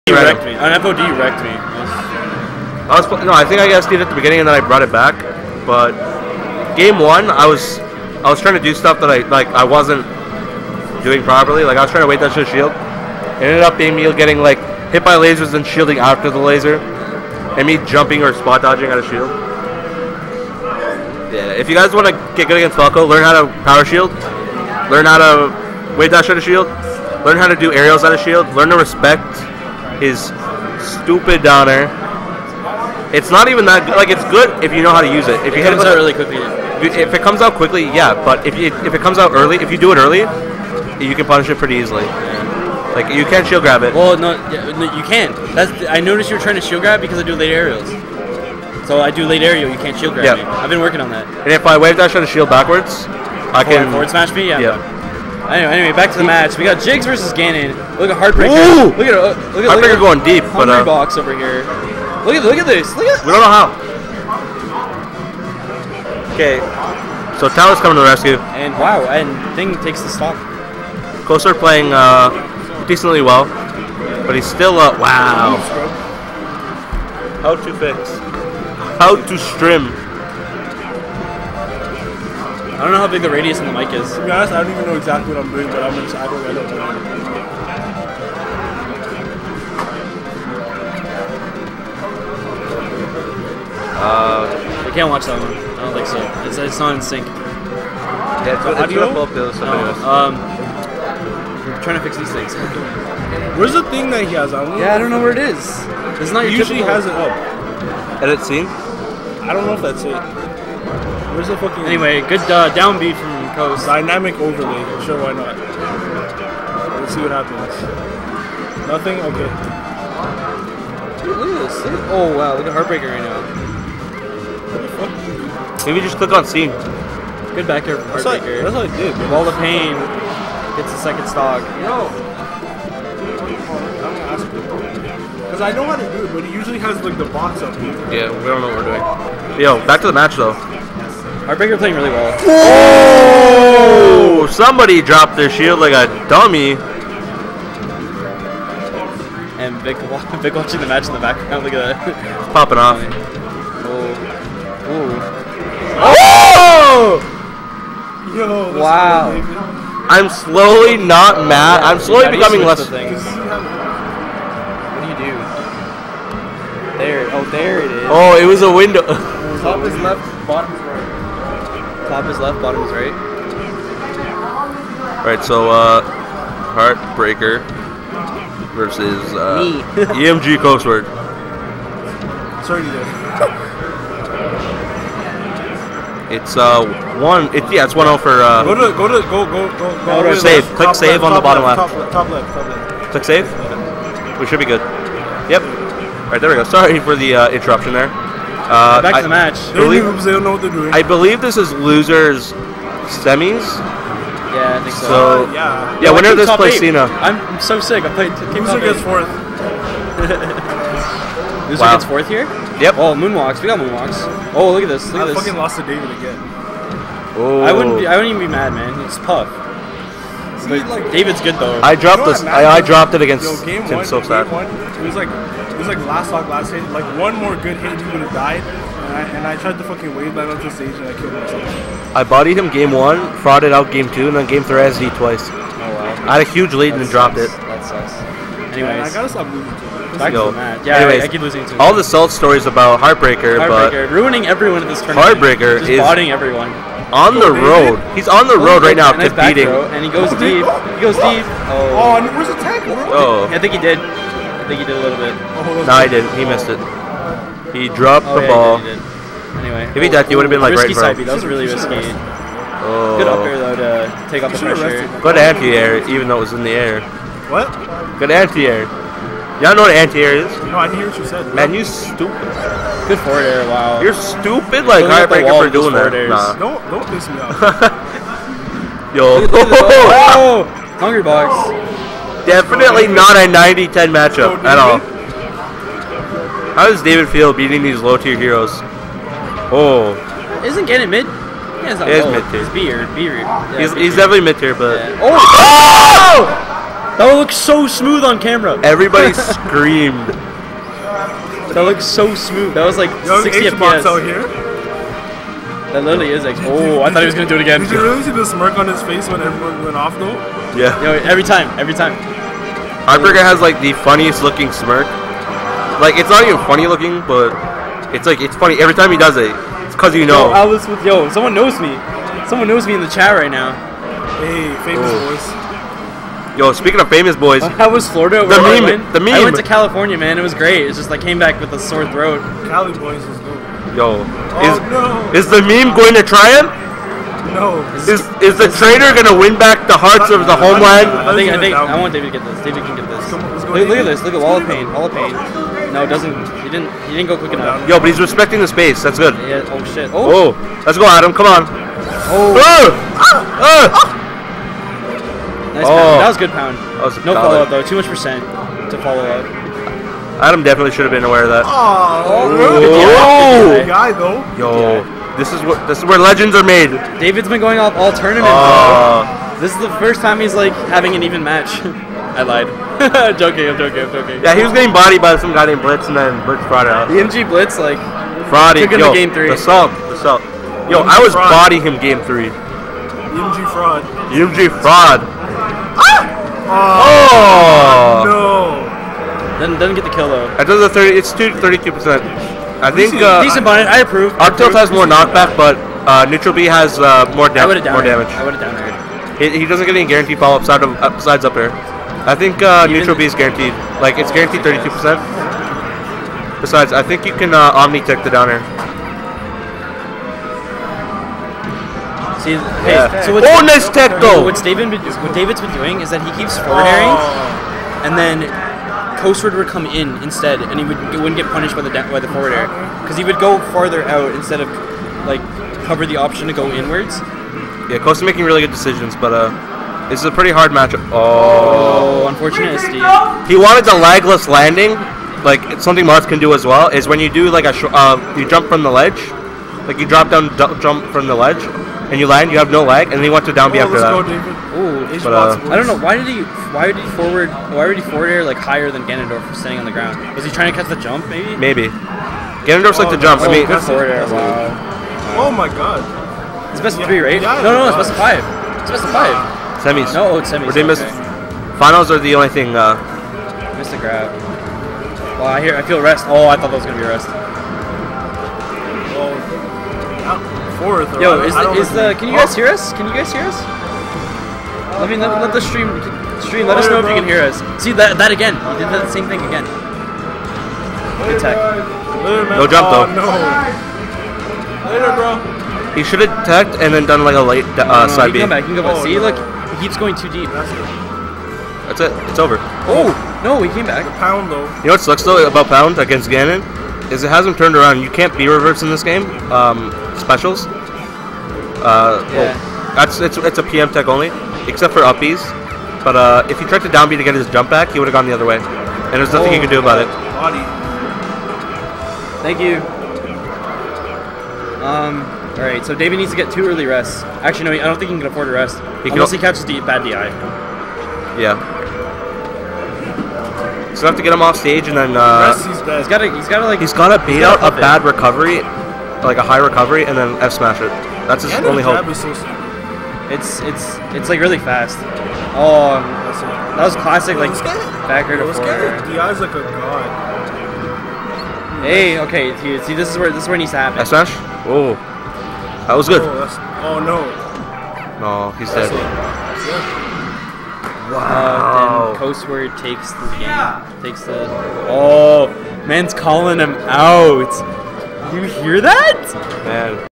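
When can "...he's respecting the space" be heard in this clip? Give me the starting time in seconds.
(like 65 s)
348 s.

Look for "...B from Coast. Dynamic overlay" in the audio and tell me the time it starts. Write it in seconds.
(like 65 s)
112 s.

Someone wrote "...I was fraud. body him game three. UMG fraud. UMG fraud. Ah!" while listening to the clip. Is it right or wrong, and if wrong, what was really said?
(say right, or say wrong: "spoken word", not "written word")
right.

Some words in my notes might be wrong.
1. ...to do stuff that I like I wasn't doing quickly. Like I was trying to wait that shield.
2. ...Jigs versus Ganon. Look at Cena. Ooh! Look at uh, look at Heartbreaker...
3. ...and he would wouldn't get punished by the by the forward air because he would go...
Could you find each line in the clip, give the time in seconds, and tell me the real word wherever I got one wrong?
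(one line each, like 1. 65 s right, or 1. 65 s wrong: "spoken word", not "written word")
1. 8 s wrong: "properly", not "quickly"
2. 56 s wrong: "Heartbreaker", not "Cena"
3. 420 s right.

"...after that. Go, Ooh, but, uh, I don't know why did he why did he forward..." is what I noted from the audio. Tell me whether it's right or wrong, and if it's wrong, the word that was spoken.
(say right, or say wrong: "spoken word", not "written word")
right.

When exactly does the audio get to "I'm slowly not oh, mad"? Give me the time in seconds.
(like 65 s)
160 s.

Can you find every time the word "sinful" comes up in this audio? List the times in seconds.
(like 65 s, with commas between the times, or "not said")
not said.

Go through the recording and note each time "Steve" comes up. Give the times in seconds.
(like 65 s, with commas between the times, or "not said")
3 s, 432 s.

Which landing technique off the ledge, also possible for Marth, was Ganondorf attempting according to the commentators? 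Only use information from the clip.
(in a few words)
legless landing.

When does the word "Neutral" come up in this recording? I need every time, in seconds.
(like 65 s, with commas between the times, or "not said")
396 s, 402 s.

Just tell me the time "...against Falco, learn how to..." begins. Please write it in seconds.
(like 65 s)
22 s.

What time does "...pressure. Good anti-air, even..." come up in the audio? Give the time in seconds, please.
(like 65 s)
264 s.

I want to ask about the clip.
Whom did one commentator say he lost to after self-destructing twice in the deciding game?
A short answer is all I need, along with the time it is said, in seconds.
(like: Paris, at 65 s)
Tim Silvstad, at 223 s.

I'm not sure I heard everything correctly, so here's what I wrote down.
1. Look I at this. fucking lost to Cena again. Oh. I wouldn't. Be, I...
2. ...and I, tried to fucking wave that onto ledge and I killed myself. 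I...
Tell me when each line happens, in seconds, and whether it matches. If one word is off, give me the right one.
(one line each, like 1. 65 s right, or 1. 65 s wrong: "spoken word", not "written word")
1. 215 s wrong: "David", not "Cena"
2. 229 s wrong: "stage", not "ledge".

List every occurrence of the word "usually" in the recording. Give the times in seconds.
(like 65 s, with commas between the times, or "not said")
106 s, 136 s.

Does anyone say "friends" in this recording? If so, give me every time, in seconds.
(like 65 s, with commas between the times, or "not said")
not said.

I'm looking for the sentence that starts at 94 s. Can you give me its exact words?
Uh, we can't watch that one.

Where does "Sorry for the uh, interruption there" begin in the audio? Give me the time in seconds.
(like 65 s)
196 s.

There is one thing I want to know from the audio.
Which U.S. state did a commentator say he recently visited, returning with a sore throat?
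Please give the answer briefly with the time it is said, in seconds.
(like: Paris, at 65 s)
California, at 329 s.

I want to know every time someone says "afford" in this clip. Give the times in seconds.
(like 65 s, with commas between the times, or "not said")
518 s.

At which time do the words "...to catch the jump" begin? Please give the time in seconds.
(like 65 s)
450 s.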